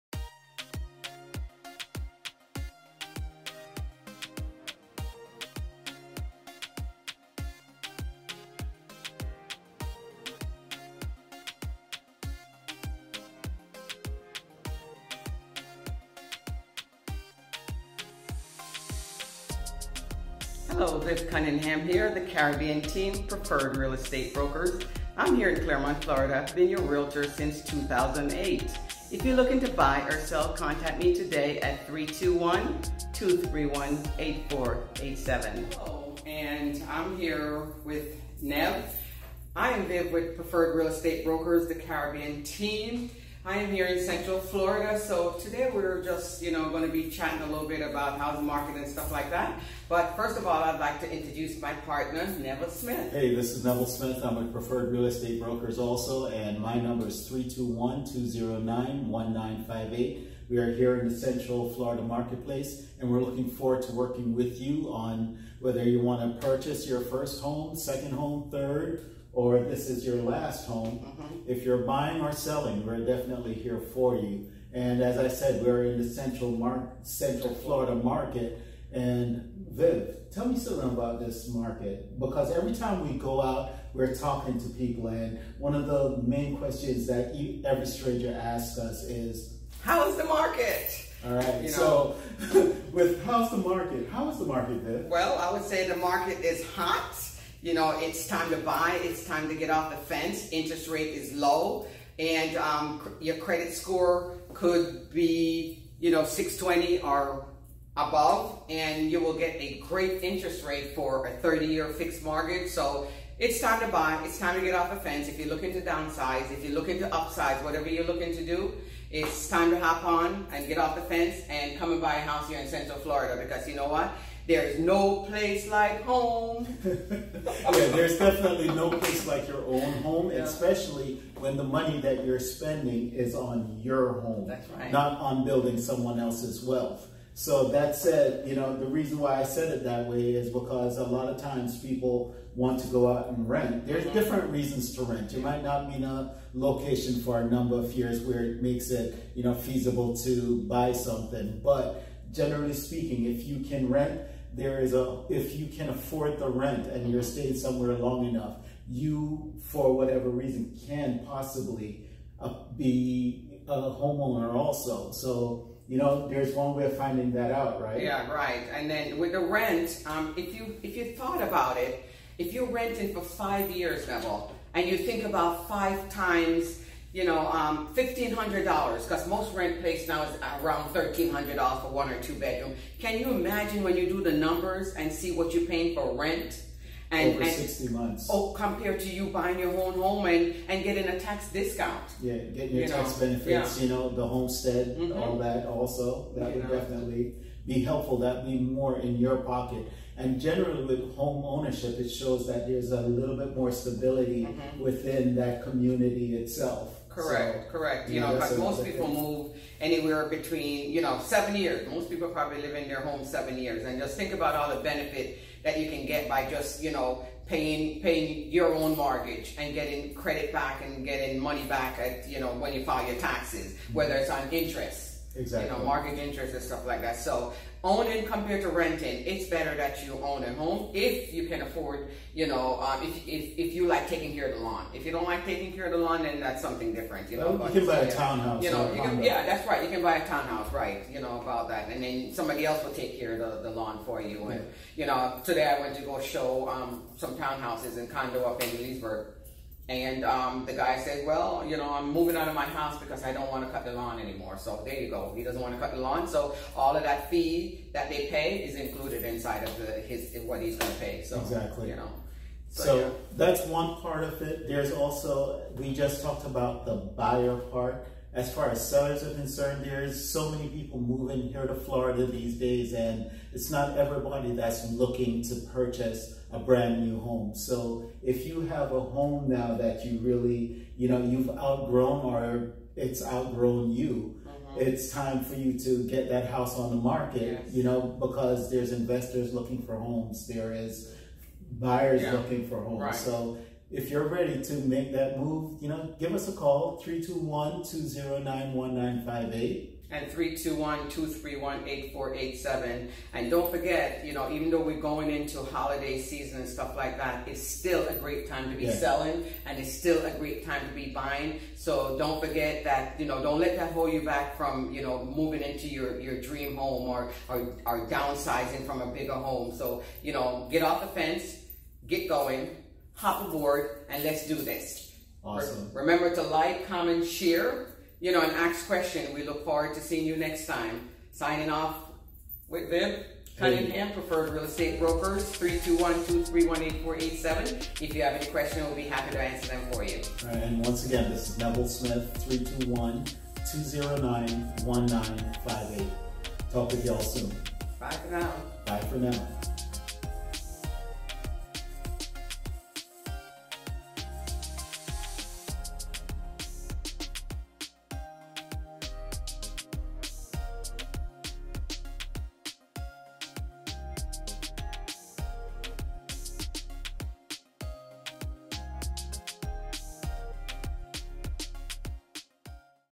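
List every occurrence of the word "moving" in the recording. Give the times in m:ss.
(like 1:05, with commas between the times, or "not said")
4:12, 4:31, 5:15.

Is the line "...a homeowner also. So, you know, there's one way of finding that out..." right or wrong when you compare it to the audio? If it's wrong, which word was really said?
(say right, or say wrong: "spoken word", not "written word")
right.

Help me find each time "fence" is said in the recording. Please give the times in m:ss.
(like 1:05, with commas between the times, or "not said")
1:39, 1:54, 2:01, 5:21.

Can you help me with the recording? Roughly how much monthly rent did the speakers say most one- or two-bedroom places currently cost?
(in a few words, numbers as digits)
$1,300.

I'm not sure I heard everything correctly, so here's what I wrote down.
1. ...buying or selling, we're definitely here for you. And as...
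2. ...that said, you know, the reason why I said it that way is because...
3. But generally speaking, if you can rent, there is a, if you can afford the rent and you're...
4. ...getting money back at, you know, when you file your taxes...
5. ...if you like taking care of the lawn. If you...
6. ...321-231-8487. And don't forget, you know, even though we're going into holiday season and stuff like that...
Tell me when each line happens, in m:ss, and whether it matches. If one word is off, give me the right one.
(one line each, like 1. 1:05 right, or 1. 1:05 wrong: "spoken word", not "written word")
1. 1:11 right
2. 2:17 right
3. 2:31 right
4. 3:41 right
5. 3:53 right
6. 5:00 right.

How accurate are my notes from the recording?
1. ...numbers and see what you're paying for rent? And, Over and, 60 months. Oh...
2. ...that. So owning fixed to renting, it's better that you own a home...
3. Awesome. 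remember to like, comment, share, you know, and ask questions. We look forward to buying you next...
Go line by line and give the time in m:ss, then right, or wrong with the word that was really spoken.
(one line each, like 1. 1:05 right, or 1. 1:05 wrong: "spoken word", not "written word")
1. 3:04 right
2. 3:47 wrong: "compared", not "fixed"
3. 5:25 wrong: "seeing", not "buying".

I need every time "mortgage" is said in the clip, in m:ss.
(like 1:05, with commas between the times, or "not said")
1:52, 3:38.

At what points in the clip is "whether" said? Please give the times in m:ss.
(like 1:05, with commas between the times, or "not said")
1:05, 3:43.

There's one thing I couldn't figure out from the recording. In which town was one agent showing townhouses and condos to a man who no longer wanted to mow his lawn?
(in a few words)
Leesburg.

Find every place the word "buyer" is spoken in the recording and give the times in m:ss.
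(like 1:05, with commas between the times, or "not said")
4:26, 4:51.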